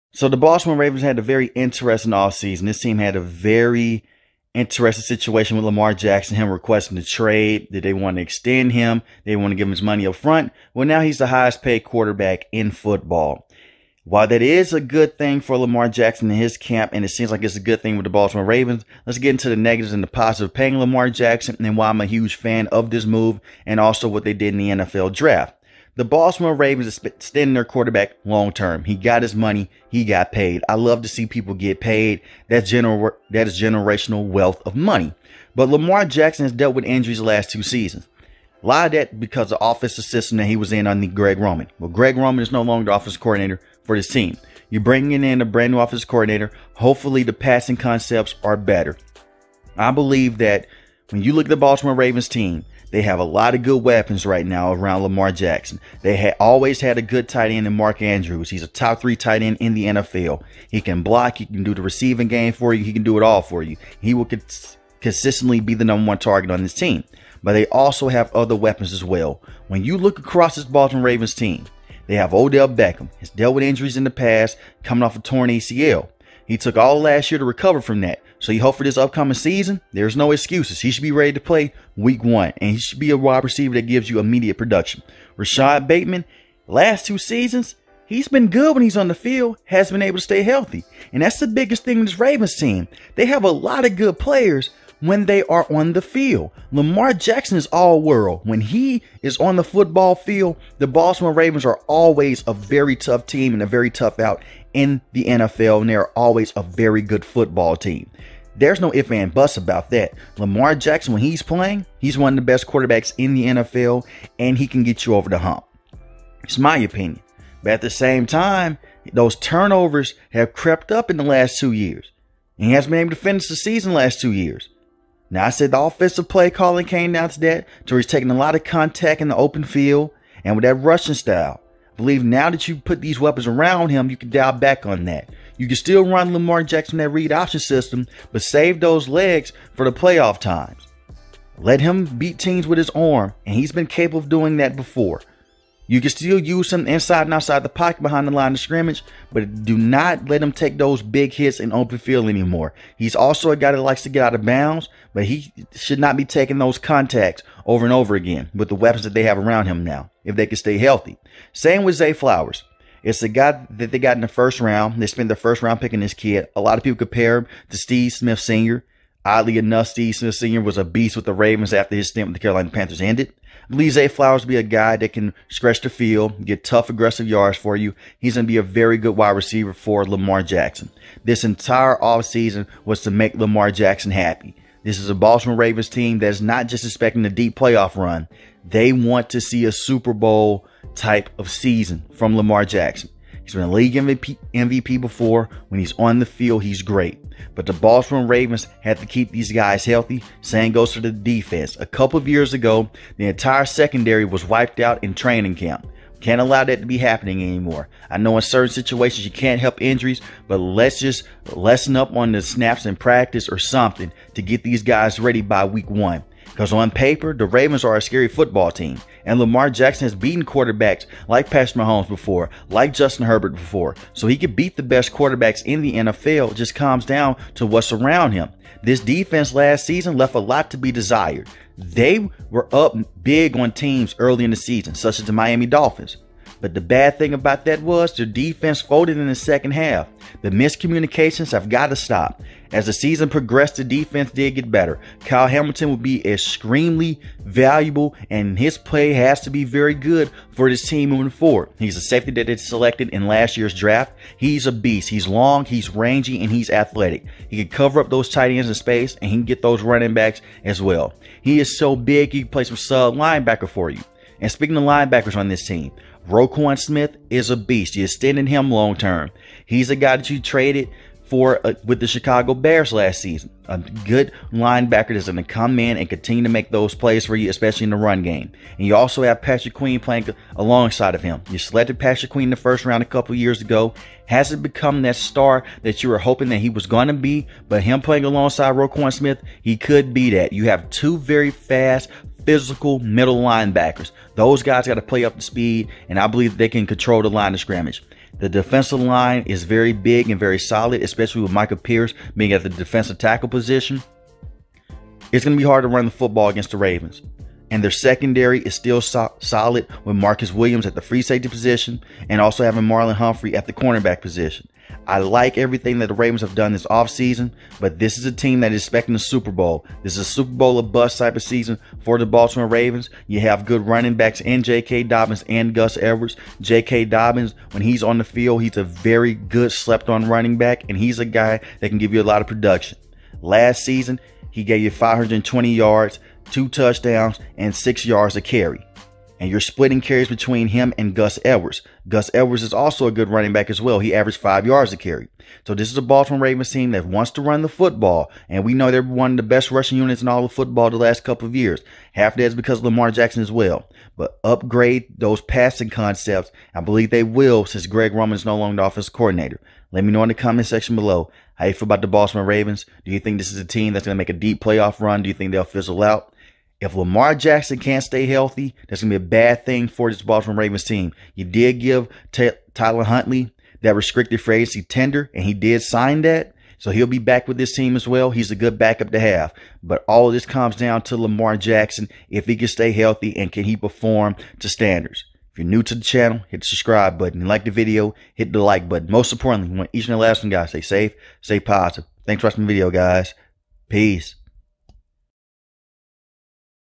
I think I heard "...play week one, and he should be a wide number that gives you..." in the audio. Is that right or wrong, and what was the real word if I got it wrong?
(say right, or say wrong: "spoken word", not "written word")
wrong: "receiver", not "number".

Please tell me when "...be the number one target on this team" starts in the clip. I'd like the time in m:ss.
1:05.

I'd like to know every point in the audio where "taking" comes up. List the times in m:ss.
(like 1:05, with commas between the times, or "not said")
2:08, 2:36.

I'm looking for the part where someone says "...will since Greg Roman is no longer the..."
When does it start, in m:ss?
5:57.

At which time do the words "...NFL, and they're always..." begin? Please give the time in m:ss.
1:45.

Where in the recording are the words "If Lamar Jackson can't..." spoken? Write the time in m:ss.
6:06.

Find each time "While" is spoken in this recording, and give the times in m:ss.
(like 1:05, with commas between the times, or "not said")
0:14.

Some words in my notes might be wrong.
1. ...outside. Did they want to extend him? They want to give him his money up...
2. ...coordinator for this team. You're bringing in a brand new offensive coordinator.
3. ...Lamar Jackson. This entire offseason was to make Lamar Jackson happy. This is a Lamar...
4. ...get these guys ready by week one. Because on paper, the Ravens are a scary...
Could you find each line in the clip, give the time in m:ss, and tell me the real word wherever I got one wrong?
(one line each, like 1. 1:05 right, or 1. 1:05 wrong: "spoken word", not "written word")
1. 0:07 wrong: "trade", not "outside"
2. 0:43 right
3. 3:00 wrong: "Baltimore", not "Lamar"
4. 3:34 right.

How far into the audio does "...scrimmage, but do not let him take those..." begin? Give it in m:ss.
2:28.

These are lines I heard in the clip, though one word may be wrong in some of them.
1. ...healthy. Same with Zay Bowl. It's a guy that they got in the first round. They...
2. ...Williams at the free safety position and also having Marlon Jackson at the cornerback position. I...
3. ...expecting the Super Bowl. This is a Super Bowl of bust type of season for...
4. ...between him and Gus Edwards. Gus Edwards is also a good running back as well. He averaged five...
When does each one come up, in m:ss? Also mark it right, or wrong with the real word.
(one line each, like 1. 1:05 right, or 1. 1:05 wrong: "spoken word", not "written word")
1. 2:40 wrong: "Flowers", not "Bowl"
2. 5:10 wrong: "Humphrey", not "Jackson"
3. 5:18 right
4. 5:40 right.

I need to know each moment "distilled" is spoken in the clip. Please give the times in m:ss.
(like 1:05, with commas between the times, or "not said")
not said.